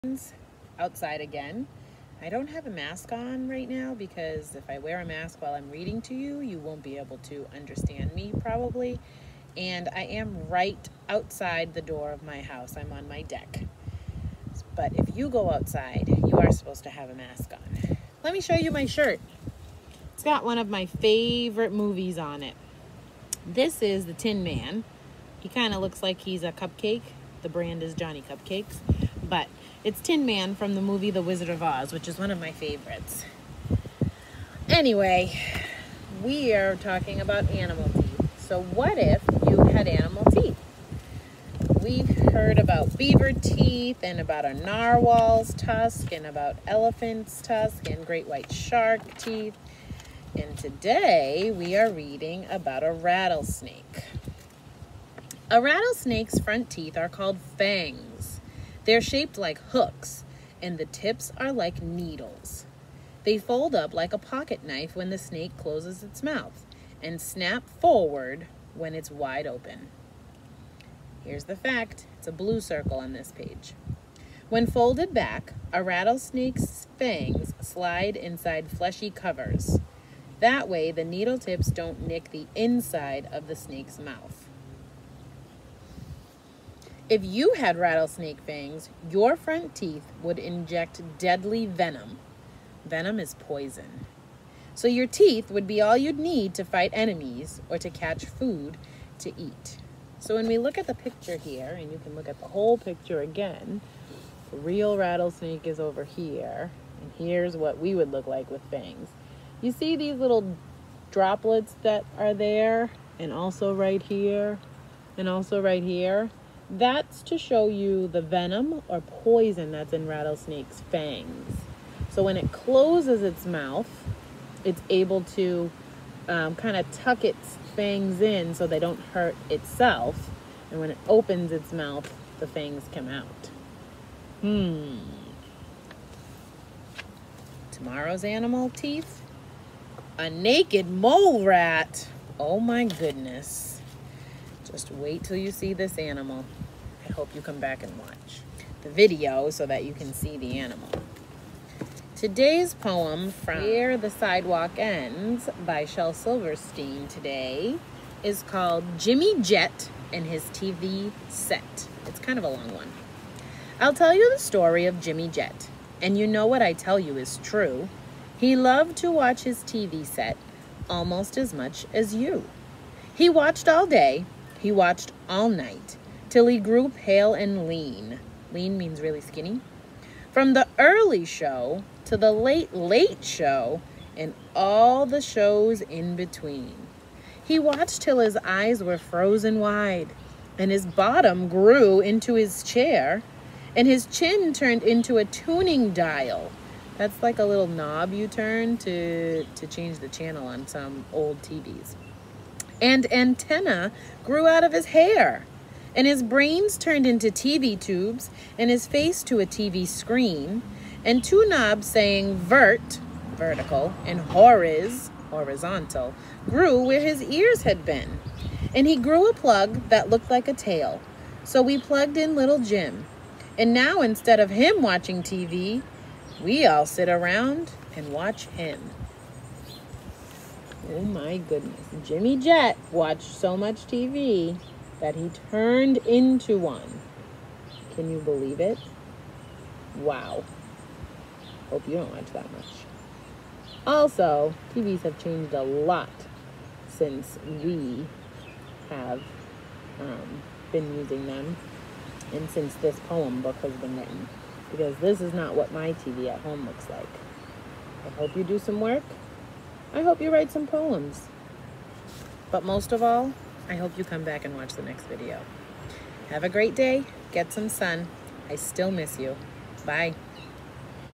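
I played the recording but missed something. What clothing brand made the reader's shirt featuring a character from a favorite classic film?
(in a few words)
Johnny Cupcakes.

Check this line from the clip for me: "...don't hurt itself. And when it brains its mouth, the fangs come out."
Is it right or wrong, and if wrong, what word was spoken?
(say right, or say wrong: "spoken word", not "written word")
wrong: "opens", not "brains".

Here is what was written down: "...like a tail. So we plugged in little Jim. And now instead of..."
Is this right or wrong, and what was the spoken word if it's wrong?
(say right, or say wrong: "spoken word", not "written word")
right.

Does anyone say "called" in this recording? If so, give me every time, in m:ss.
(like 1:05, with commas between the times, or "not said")
0:57, 2:38.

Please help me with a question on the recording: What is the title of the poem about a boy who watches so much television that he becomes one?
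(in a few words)
Jimmy Jet and His TV Set.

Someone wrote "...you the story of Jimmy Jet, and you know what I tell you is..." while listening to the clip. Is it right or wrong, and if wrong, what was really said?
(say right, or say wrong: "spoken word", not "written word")
right.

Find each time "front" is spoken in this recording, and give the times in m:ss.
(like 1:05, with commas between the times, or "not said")
0:56, 1:29.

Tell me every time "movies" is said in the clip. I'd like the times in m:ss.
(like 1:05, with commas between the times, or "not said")
0:21, 0:30.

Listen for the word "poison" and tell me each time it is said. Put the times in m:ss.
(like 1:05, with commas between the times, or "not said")
1:33, 1:59.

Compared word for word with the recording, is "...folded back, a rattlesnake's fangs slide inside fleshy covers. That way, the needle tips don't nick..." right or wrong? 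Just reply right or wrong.
right.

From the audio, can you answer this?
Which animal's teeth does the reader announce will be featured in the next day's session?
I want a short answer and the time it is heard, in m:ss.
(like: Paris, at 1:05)
Naked mole rat, at 2:20.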